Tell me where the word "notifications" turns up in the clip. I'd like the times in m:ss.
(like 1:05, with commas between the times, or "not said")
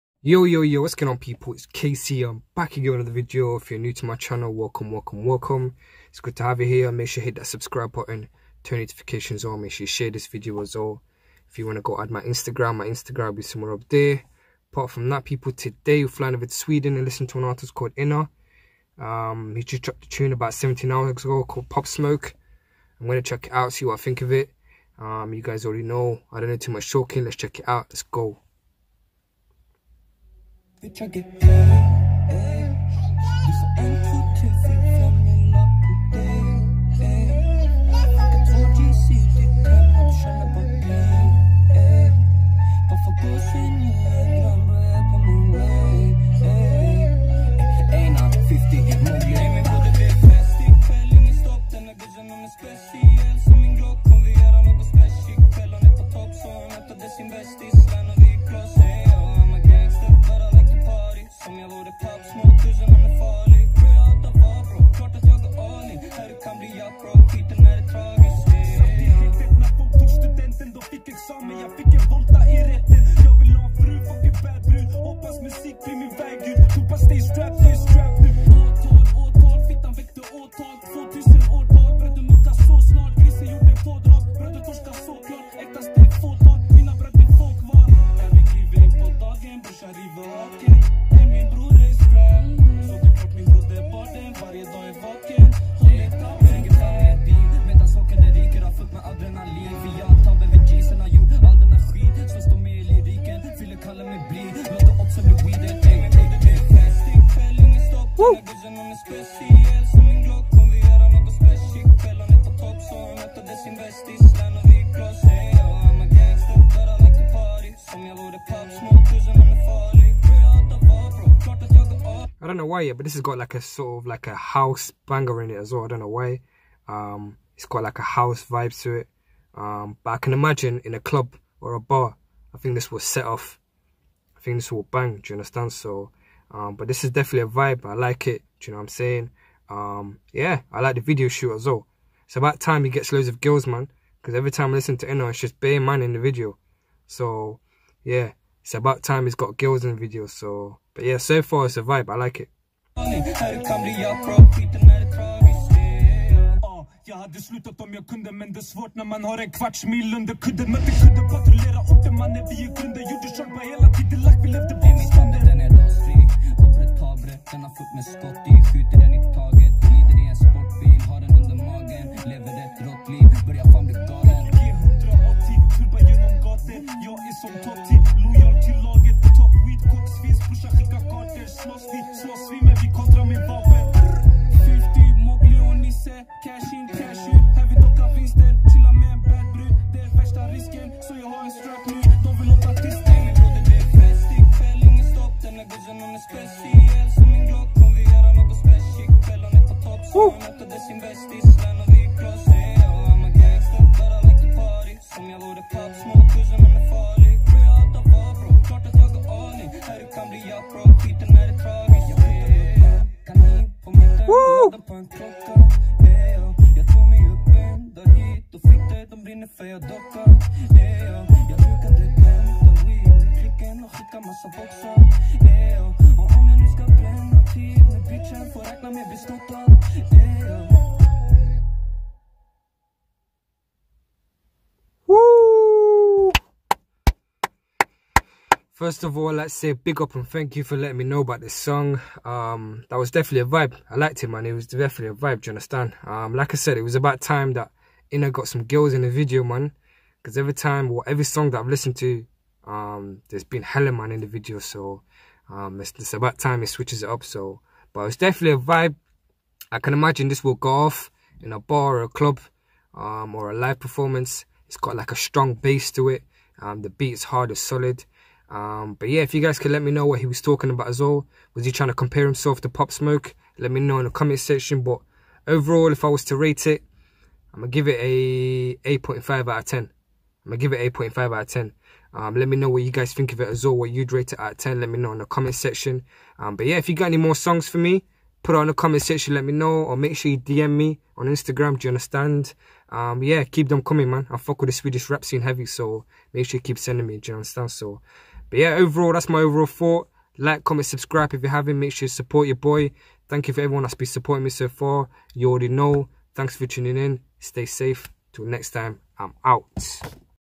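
0:08.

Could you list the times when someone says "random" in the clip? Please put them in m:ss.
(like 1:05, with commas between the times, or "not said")
not said.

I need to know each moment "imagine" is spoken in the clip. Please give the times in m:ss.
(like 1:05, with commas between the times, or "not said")
2:10, 4:19.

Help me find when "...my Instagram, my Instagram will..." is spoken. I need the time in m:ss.
0:12.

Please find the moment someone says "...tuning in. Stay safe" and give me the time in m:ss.
5:06.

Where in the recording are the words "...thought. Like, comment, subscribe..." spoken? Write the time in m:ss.
4:59.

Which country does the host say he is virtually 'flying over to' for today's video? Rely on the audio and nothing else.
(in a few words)
Sweden.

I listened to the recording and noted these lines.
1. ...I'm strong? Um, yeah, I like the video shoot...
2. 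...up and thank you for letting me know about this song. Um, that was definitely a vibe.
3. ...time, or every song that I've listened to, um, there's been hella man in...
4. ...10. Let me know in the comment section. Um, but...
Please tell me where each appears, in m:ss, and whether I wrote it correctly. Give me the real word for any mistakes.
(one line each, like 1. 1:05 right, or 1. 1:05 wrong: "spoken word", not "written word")
1. 2:18 wrong: "saying", not "strong"
2. 4:00 right
3. 4:10 right
4. 4:44 right.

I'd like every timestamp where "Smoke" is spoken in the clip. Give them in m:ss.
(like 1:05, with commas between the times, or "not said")
0:21, 4:32.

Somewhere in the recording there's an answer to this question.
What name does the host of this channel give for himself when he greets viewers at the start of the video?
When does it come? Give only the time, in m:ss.
0:01.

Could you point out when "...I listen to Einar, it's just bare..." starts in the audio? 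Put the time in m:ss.
2:24.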